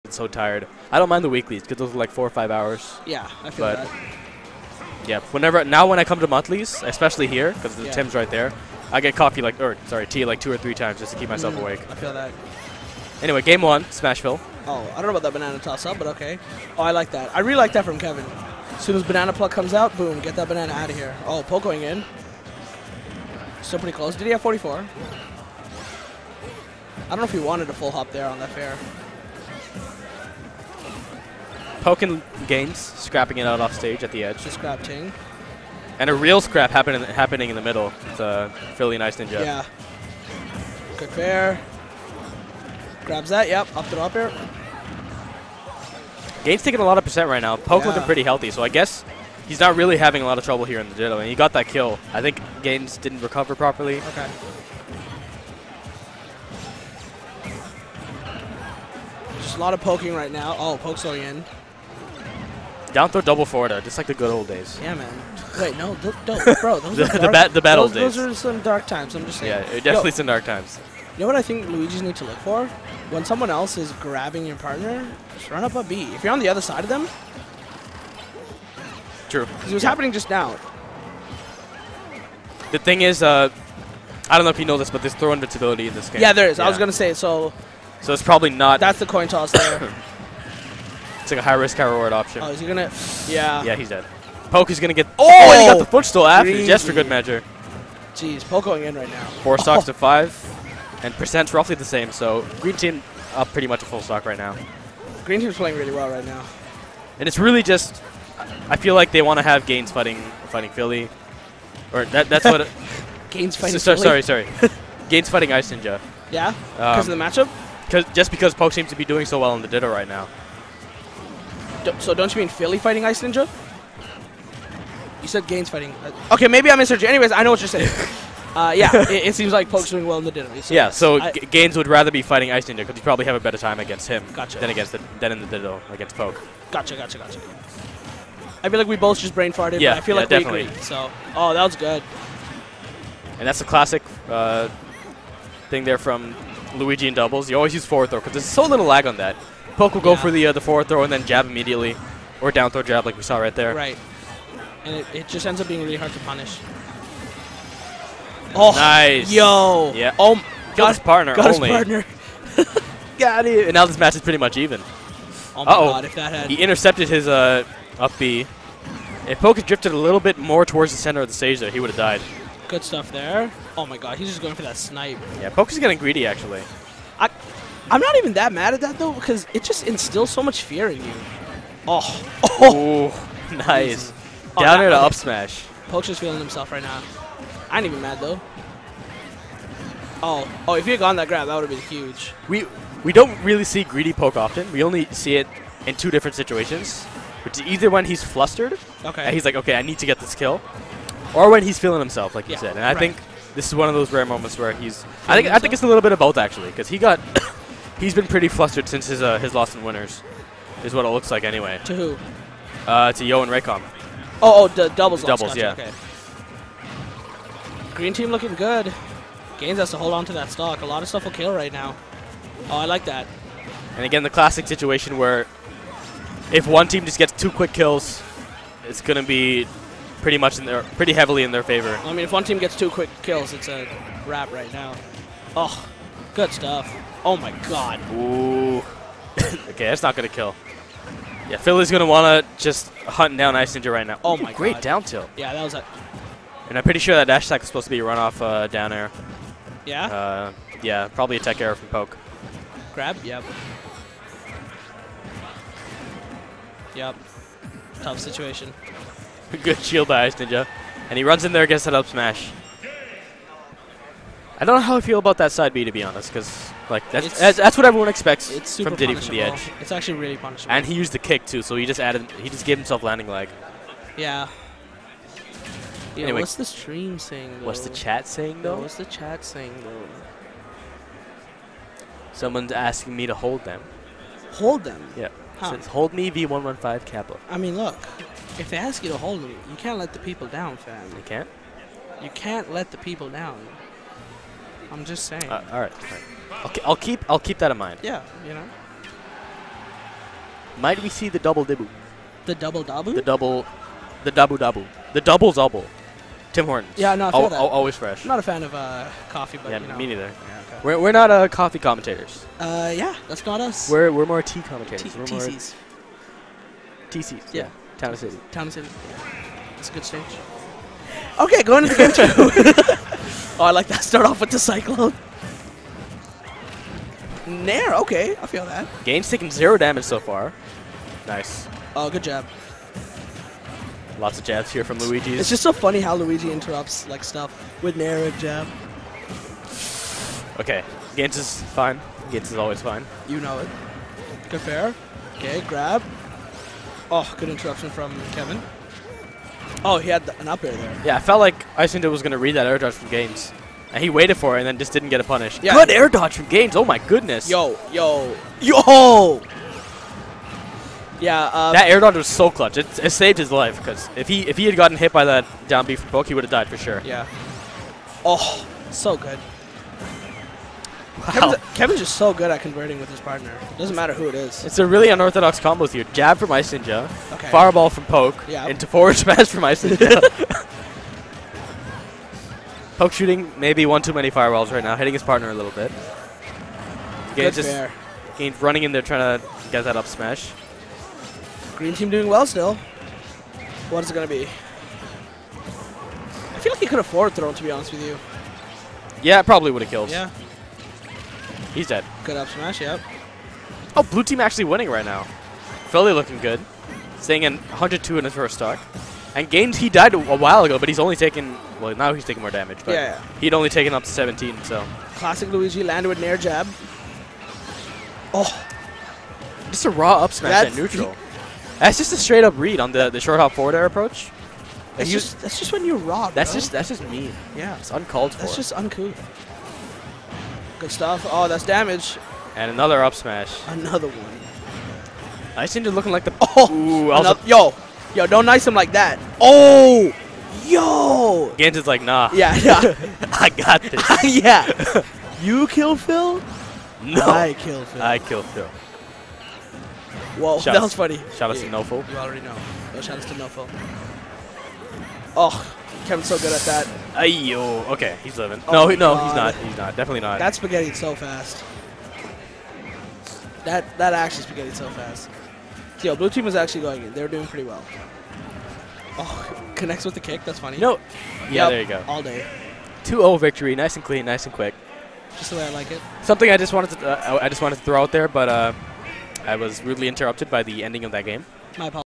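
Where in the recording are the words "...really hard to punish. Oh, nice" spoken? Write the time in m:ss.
2:35.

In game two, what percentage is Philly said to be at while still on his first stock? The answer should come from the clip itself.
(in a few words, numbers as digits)
102.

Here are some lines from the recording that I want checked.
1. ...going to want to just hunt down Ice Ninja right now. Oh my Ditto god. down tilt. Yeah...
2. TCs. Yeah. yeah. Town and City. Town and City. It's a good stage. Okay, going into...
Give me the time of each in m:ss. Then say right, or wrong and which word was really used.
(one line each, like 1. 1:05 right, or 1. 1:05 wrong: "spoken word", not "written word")
1. 4:01 wrong: "Great", not "Ditto"
2. 5:17 right.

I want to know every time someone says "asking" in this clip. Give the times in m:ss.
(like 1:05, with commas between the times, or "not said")
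4:42.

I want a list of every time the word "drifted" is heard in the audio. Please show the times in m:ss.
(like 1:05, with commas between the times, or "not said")
2:49.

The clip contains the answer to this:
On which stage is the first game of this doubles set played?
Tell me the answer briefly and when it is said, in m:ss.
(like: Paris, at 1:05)
Smashville, at 0:13.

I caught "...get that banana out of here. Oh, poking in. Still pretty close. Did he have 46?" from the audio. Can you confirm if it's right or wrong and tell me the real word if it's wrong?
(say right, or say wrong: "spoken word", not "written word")
wrong: "44", not "46".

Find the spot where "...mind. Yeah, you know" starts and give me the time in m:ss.
4:57.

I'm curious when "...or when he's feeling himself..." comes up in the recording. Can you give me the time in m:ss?
3:21.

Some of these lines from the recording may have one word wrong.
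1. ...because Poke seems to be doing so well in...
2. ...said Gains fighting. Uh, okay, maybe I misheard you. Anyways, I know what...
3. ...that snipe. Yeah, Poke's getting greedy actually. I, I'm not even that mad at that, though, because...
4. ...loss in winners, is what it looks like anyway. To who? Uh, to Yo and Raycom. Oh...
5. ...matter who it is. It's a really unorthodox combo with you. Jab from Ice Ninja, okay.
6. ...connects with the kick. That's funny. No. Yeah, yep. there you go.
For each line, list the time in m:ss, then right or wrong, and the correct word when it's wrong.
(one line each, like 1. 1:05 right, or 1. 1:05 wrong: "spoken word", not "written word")
1. 1:58 right
2. 2:05 right
3. 2:54 right
4. 3:29 right
5. 6:13 right
6. 7:49 right.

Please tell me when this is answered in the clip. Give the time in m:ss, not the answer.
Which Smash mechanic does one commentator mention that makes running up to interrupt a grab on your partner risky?
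1:25.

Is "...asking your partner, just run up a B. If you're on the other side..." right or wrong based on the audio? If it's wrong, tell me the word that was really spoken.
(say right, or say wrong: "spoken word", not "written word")
wrong: "grabbing", not "asking".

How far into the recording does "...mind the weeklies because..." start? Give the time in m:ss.
0:01.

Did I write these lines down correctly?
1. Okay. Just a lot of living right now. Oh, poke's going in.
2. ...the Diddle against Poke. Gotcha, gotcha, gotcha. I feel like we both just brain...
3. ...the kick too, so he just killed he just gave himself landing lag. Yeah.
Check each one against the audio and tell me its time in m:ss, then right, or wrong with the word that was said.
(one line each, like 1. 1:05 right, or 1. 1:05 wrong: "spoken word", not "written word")
1. 0:53 wrong: "poking", not "living"
2. 2:15 right
3. 4:31 wrong: "added", not "killed".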